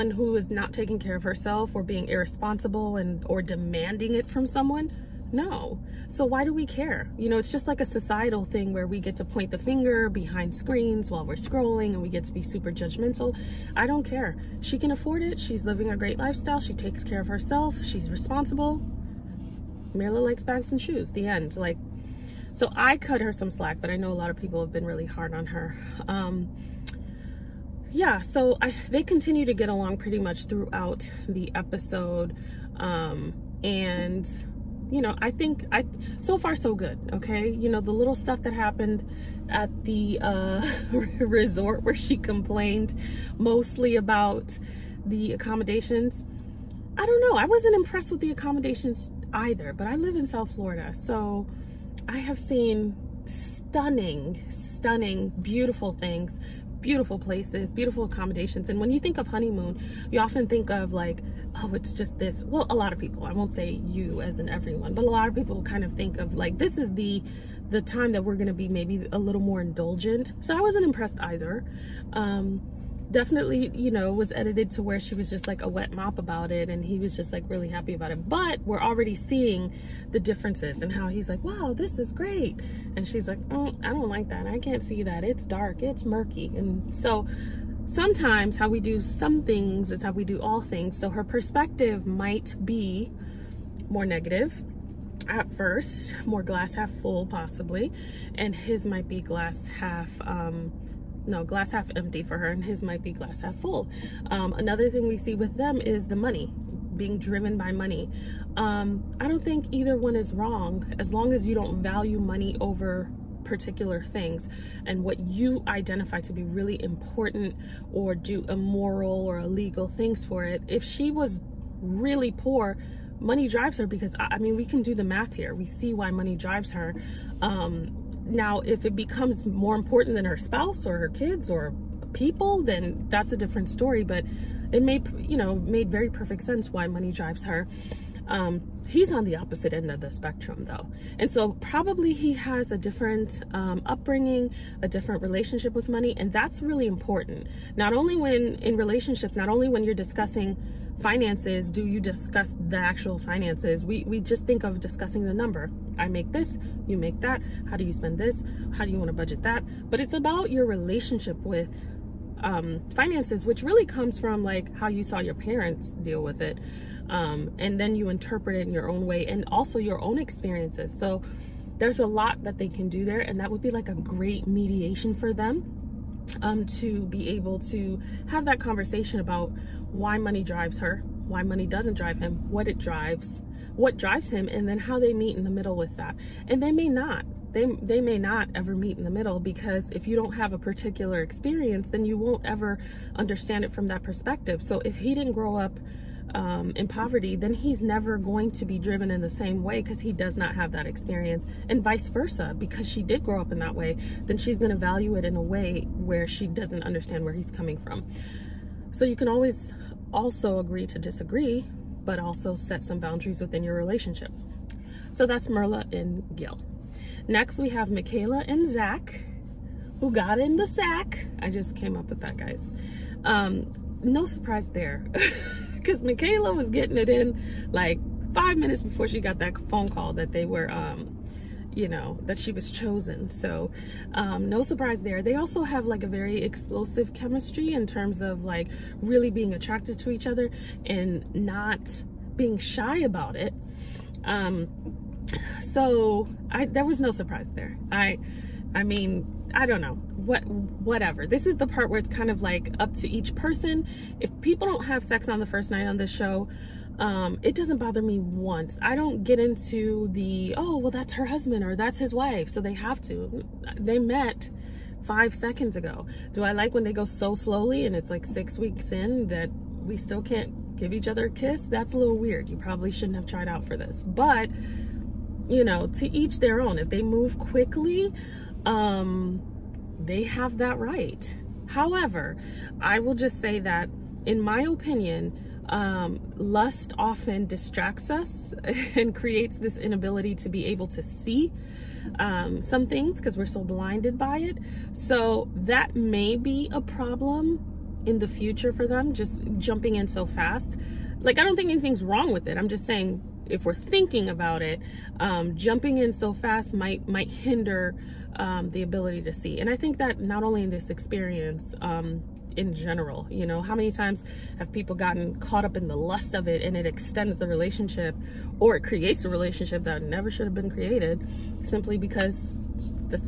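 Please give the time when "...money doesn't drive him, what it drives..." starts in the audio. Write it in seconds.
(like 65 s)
181 s.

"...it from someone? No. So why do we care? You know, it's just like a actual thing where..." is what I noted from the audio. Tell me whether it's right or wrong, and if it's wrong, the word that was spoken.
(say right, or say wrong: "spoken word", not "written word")
wrong: "societal", not "actual".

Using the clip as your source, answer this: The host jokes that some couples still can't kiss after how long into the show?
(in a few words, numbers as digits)
6 weeks.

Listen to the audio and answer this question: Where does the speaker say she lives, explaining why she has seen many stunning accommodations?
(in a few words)
South Florida.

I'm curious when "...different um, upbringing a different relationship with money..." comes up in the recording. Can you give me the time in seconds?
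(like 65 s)
142 s.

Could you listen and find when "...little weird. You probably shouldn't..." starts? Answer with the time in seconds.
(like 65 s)
271 s.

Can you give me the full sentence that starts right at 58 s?
And when you think of honeymoon, you often think of like, oh, it's just this.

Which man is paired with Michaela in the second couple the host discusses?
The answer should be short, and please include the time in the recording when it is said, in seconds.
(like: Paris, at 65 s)
Zach, at 218 s.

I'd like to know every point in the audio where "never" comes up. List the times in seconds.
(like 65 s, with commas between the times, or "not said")
197 s, 320 s.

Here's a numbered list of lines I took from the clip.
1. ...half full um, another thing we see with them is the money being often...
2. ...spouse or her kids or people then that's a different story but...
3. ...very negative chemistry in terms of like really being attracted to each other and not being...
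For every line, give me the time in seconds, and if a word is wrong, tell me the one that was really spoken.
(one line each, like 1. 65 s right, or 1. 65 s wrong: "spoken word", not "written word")
1. 103 s wrong: "driven", not "often"
2. 130 s right
3. 236 s wrong: "explosive", not "negative".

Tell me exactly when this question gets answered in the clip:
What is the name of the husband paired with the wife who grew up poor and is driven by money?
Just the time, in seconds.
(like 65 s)
216 s.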